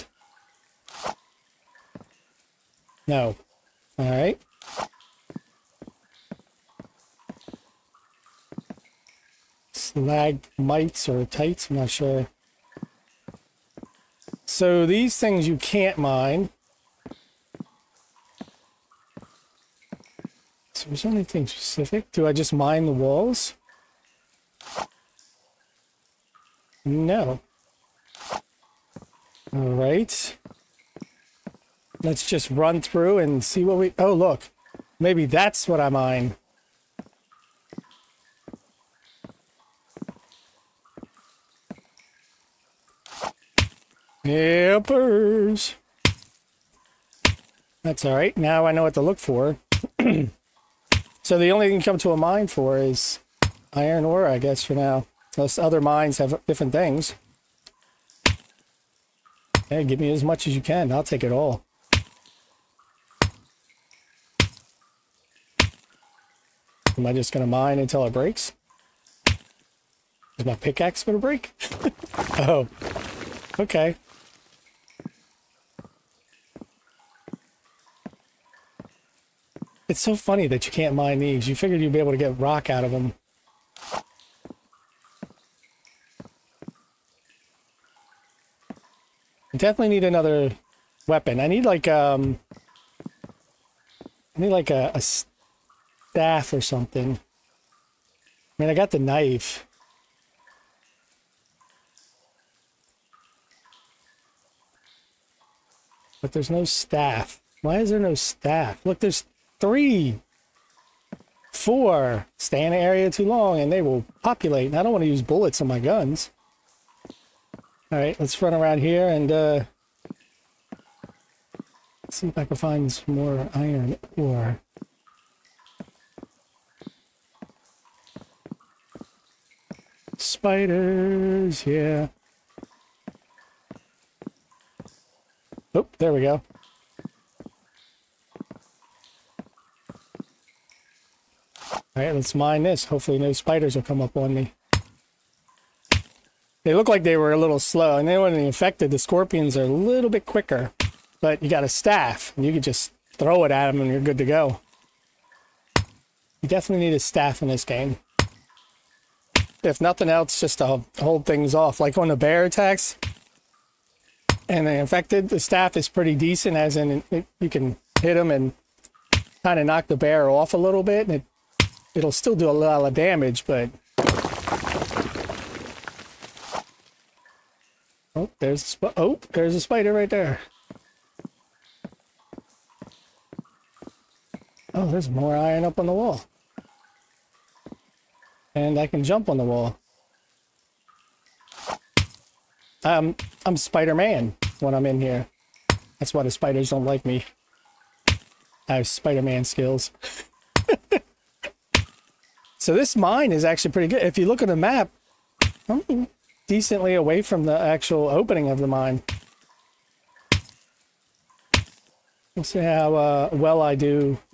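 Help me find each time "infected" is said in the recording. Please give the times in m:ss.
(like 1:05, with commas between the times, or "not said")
2:28, 2:44.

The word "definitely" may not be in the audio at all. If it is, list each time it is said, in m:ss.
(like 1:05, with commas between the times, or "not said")
1:29, 2:36.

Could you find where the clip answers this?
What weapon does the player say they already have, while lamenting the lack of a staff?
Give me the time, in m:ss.
1:38.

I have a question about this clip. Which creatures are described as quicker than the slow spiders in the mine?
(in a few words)
Scorpions.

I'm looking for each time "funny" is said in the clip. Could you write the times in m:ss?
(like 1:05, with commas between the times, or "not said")
1:20.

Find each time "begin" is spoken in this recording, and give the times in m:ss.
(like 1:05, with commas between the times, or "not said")
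not said.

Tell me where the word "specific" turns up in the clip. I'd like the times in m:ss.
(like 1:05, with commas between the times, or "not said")
0:21.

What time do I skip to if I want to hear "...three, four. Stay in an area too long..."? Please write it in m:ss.
1:49.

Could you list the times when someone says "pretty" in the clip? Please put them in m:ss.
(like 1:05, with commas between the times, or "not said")
2:45, 3:23.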